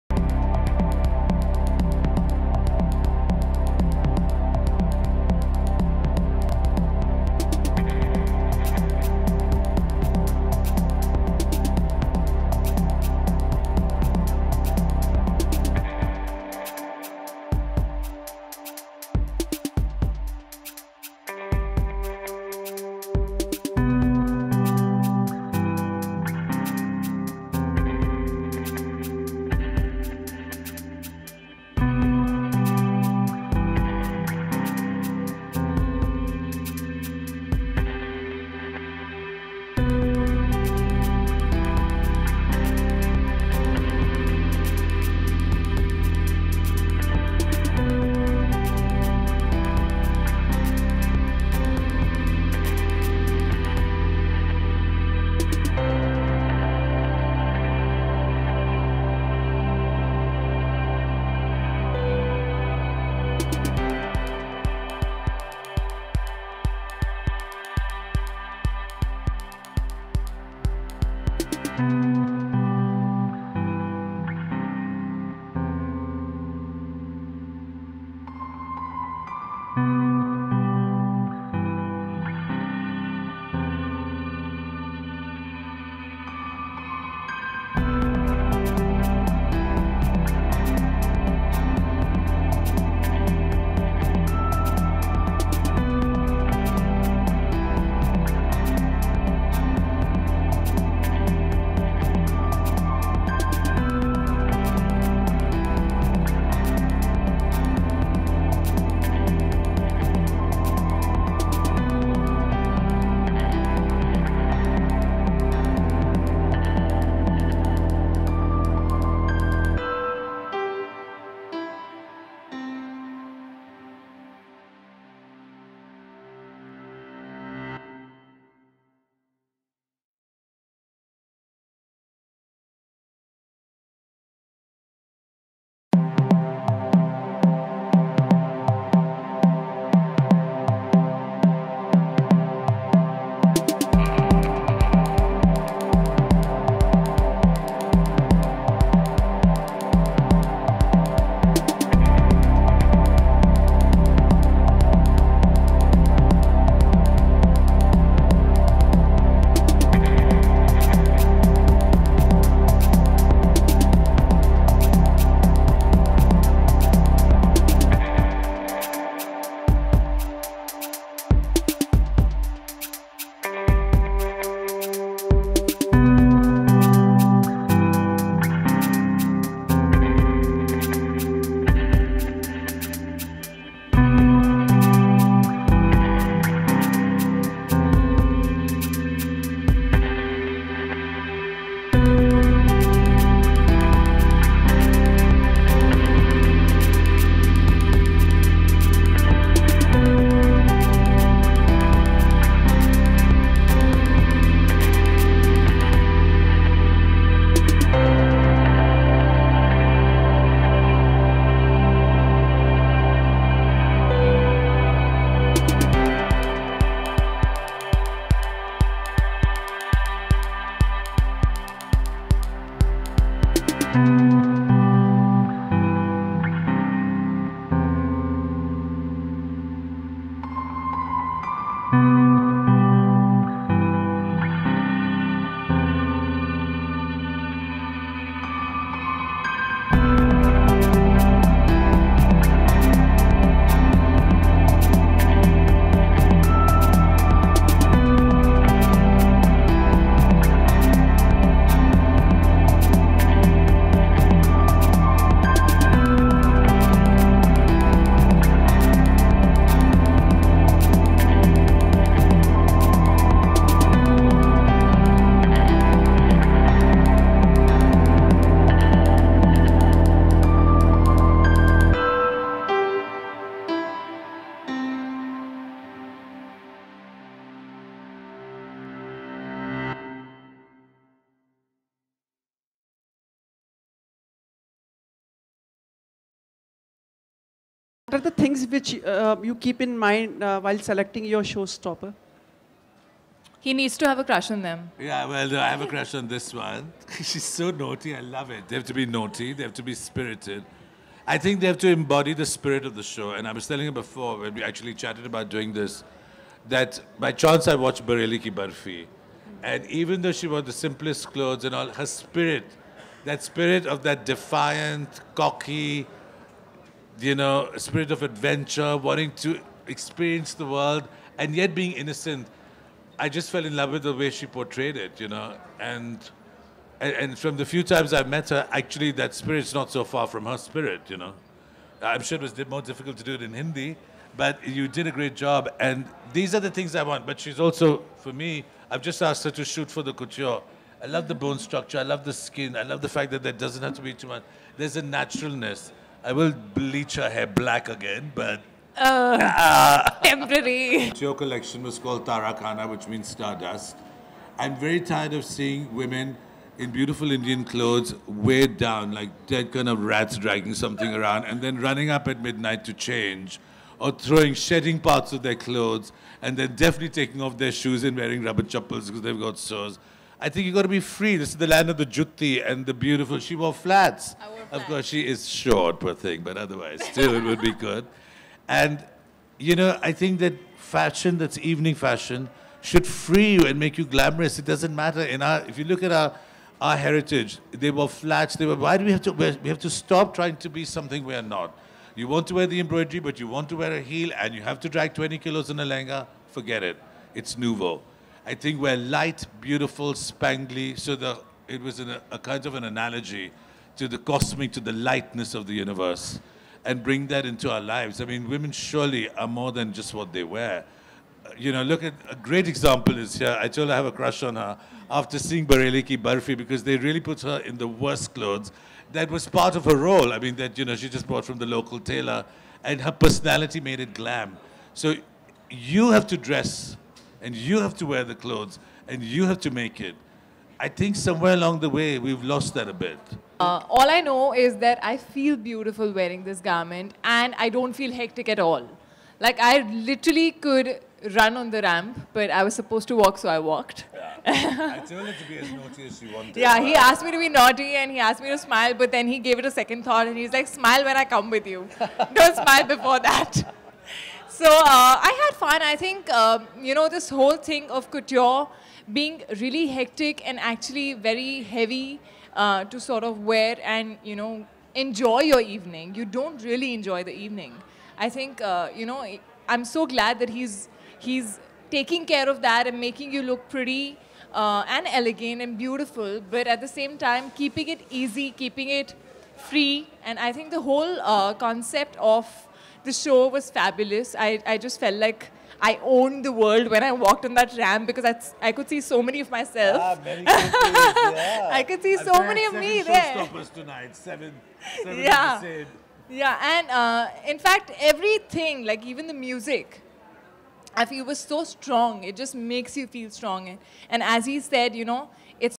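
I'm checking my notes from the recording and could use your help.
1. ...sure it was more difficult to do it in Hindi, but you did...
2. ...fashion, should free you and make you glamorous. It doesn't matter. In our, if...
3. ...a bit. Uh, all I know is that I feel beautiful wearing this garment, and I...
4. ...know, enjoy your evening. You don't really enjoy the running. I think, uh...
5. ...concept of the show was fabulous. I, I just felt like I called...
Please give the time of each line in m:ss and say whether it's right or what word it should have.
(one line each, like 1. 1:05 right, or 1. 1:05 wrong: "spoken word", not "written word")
1. 5:32 right
2. 6:21 right
3. 7:12 right
4. 7:44 wrong: "evening", not "running"
5. 8:01 wrong: "owned", not "called".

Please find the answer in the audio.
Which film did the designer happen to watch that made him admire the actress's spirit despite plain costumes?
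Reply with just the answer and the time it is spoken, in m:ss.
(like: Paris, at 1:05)
Bareilly Ki Barfi, at 5:08.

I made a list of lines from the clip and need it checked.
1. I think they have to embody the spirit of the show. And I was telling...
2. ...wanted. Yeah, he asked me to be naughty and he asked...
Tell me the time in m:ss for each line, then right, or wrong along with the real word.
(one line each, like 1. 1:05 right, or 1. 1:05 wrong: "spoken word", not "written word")
1. 5:01 right
2. 7:26 right.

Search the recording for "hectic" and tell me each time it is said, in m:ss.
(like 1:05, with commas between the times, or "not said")
7:18, 7:39.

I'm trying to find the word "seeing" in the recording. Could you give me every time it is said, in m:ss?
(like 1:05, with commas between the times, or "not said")
5:55, 6:55.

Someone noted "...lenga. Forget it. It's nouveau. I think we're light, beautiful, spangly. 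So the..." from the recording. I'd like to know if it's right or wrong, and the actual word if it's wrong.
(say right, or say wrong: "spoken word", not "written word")
right.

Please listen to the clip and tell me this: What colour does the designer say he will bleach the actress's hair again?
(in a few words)
black.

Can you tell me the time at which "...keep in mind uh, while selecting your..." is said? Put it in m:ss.
4:49.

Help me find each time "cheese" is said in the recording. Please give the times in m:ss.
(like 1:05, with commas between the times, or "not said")
not said.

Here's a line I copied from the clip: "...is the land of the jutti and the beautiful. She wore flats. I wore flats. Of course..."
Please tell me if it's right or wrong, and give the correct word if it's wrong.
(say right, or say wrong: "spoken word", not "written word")
right.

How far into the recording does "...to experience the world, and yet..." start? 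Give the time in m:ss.
5:19.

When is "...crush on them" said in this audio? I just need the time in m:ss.
4:54.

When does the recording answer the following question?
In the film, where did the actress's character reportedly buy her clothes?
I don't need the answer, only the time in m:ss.
7:01.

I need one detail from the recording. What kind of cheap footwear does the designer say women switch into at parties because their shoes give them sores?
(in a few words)
rubber chappals.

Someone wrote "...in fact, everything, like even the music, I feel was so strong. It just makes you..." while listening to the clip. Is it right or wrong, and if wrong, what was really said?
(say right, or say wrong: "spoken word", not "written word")
right.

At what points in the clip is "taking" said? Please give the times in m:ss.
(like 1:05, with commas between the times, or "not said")
6:07, 7:51.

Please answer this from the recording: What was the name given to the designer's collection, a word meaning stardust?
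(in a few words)
Tarakana.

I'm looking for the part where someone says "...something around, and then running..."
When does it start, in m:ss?
6:00.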